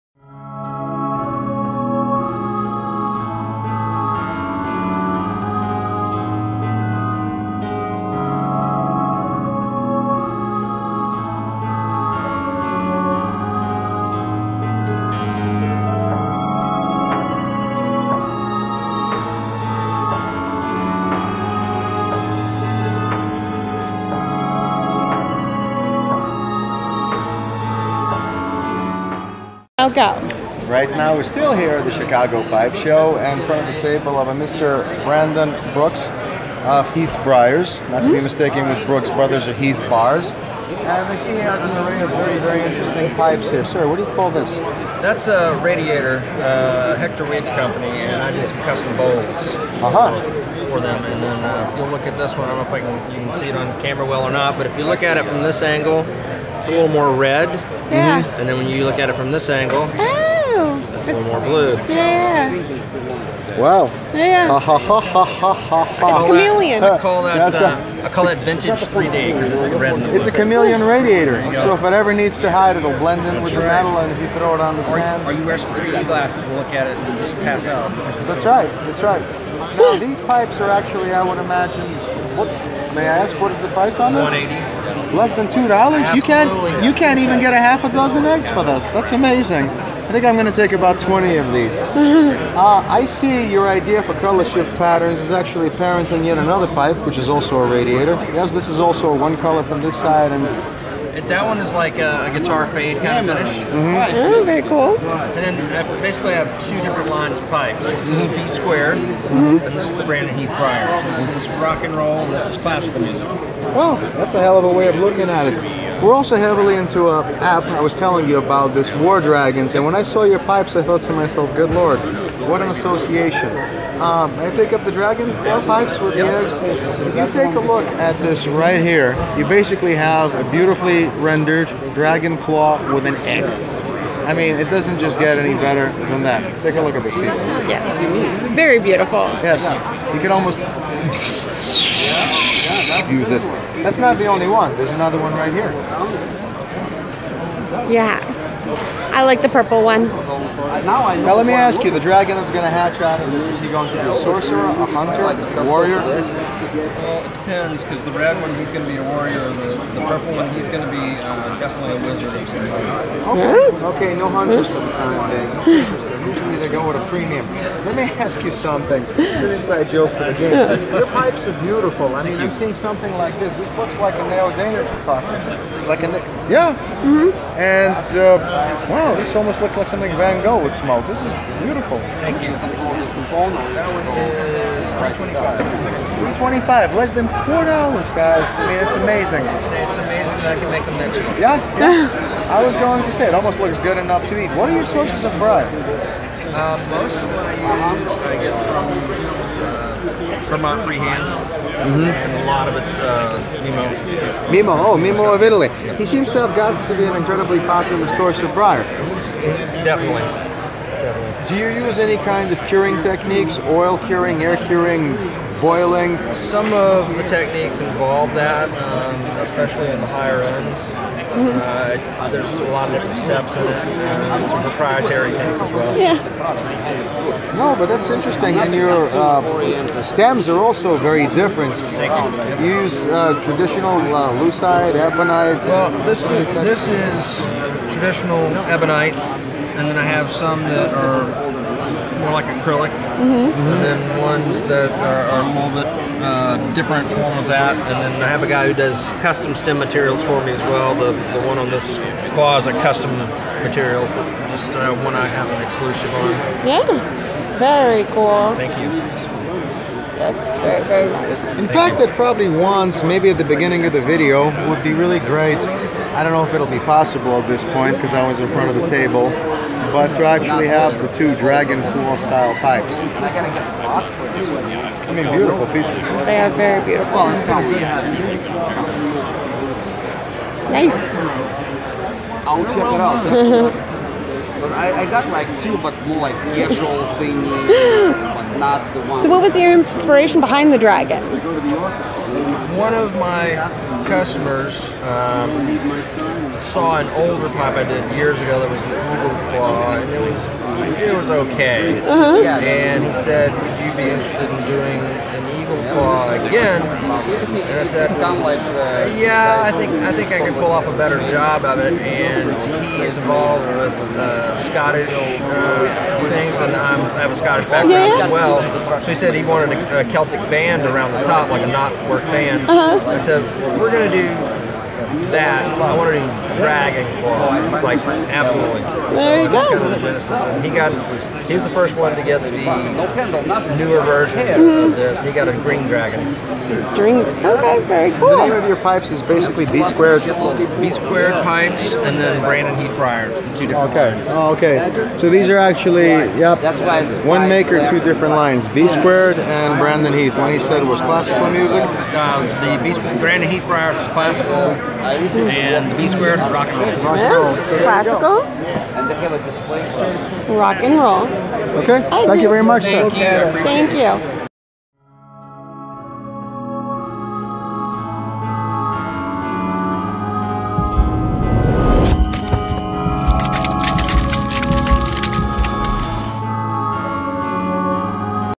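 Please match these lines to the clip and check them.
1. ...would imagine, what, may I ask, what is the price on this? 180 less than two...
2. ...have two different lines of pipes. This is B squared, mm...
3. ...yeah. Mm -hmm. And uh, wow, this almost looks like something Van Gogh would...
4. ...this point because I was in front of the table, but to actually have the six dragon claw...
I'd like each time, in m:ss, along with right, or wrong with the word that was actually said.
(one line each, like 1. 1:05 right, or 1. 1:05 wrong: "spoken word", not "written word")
1. 1:21 right
2. 1:46 right
3. 2:56 right
4. 4:27 wrong: "two", not "six".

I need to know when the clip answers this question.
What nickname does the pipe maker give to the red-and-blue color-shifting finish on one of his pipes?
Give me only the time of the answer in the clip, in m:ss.
1:08.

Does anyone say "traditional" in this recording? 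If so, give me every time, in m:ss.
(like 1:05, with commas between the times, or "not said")
3:53, 3:57.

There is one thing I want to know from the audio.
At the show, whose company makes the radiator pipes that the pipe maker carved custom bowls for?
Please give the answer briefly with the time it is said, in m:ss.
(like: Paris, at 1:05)
Hector Weed, at 0:46.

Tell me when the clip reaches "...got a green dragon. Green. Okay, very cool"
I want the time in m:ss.
5:35.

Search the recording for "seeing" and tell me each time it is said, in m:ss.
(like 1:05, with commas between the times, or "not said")
2:52.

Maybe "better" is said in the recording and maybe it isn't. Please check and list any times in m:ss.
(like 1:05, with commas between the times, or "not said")
2:15, 5:10.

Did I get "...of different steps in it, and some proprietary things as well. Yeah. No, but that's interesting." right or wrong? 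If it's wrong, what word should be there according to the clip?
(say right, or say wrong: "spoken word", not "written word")
right.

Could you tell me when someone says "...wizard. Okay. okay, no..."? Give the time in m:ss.
2:42.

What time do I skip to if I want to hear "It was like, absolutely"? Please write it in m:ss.
5:27.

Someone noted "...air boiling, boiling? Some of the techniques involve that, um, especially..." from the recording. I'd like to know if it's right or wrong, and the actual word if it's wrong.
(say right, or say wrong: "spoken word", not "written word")
wrong: "curing", not "boiling".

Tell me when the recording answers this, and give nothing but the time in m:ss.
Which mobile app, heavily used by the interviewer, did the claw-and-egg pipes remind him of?
1:58.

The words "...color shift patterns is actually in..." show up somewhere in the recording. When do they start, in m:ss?
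1:34.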